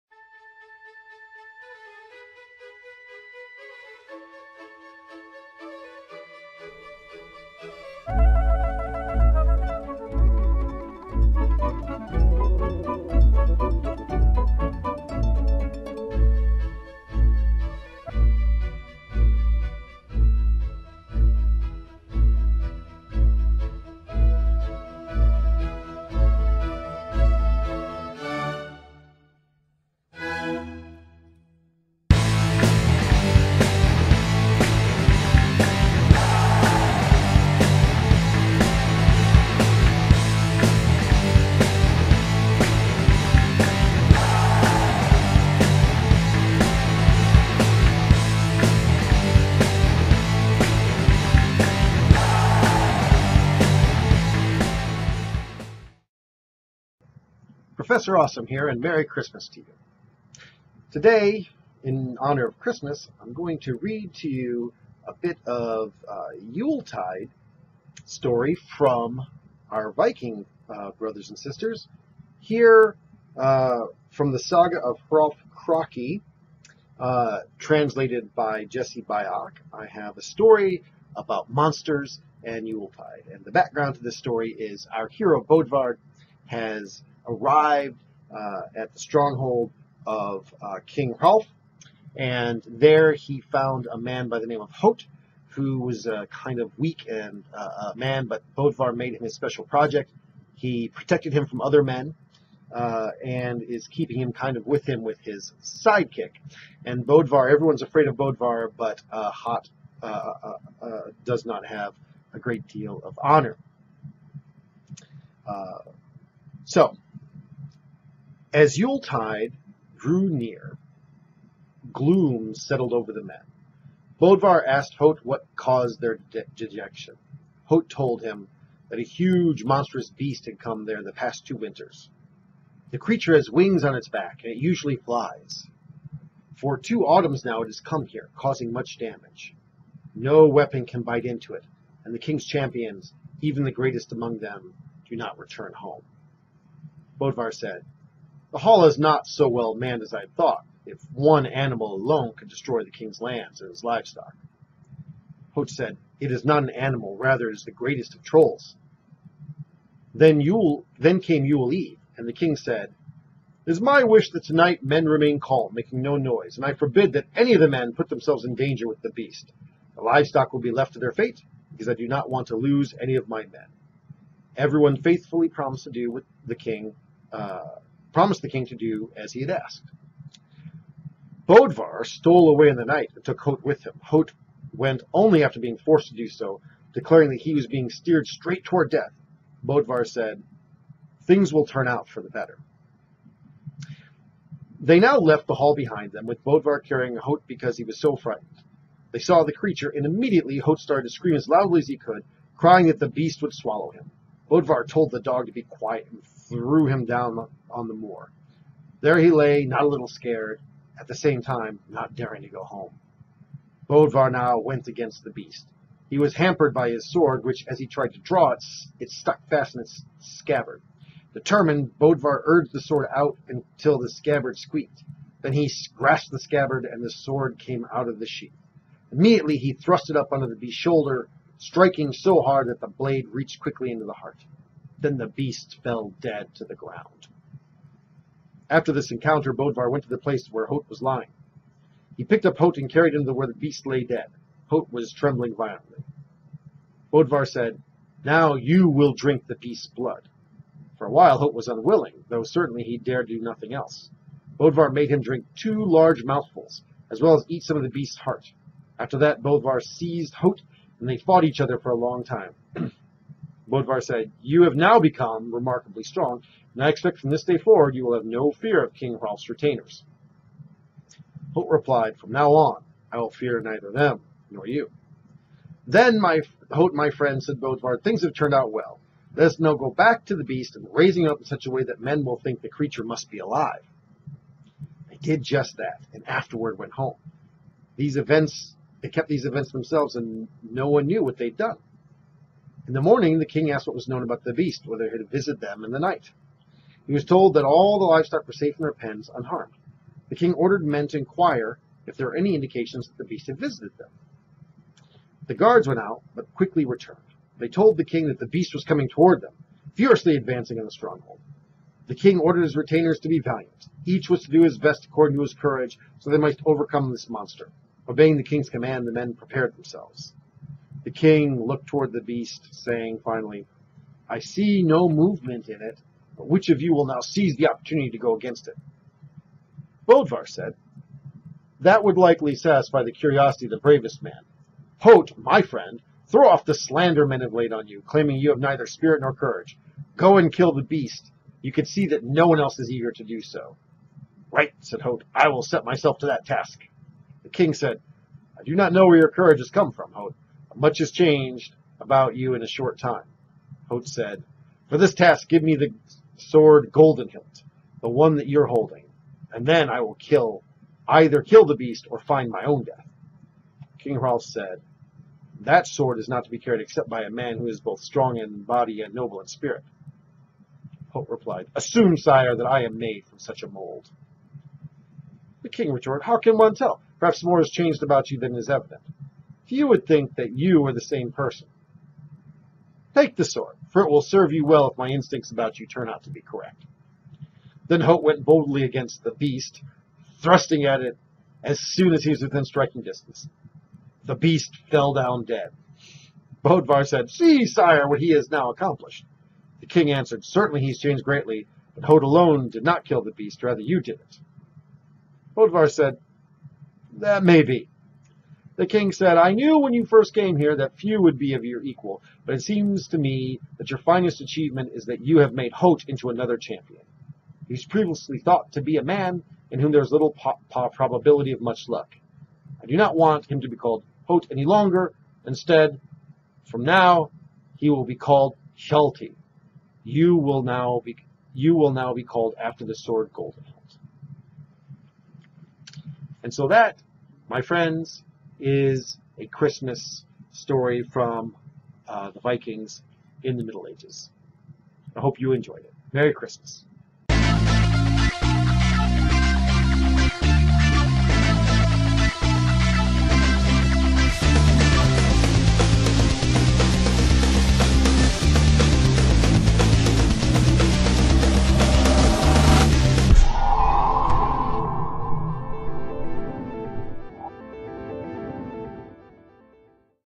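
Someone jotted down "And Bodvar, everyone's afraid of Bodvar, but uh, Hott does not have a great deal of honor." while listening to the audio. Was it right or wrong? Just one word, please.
right.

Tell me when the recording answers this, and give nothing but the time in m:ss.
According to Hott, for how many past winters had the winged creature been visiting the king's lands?
2:11.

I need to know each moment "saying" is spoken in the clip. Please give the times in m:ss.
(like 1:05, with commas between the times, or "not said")
5:22.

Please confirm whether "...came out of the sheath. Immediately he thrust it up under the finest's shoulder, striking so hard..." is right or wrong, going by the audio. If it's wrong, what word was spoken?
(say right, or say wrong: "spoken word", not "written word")
wrong: "beast", not "finest".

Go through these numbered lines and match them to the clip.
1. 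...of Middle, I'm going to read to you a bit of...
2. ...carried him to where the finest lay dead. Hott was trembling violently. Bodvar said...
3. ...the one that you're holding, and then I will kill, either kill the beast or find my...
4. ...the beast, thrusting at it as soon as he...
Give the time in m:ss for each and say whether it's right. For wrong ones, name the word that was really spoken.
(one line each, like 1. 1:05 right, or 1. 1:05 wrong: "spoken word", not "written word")
1. 1:02 wrong: "Christmas", not "Middle"
2. 4:02 wrong: "beast", not "finest"
3. 5:58 right
4. 6:29 right.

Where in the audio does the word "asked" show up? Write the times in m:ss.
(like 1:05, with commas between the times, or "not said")
2:04, 2:59, 4:53.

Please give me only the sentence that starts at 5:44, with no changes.
Right, said Hott, I will set myself to that task.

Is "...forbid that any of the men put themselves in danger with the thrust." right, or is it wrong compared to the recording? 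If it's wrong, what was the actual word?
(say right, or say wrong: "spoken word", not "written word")
wrong: "beast", not "thrust".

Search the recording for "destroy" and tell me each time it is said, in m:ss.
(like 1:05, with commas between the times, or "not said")
2:32.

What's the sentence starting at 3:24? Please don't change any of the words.
Bodvar told the dog to be quiet and threw him down on the moor.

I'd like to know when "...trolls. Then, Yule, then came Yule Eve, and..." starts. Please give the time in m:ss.
2:38.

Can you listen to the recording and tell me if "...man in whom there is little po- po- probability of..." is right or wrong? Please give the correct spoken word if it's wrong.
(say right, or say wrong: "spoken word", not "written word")
right.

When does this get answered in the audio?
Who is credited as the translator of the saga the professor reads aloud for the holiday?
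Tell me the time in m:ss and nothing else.
1:18.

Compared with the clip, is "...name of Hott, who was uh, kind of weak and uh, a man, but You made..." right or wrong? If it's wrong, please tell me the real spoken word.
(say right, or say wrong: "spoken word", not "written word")
wrong: "Bodvar", not "You".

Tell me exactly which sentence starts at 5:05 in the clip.
The guards went out, but quickly returned.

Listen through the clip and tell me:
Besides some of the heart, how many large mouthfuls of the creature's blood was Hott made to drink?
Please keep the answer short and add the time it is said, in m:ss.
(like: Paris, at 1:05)
2, at 4:15.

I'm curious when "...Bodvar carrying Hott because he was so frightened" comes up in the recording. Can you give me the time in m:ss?
3:16.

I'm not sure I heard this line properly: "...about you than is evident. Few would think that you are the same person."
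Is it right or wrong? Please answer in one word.
right.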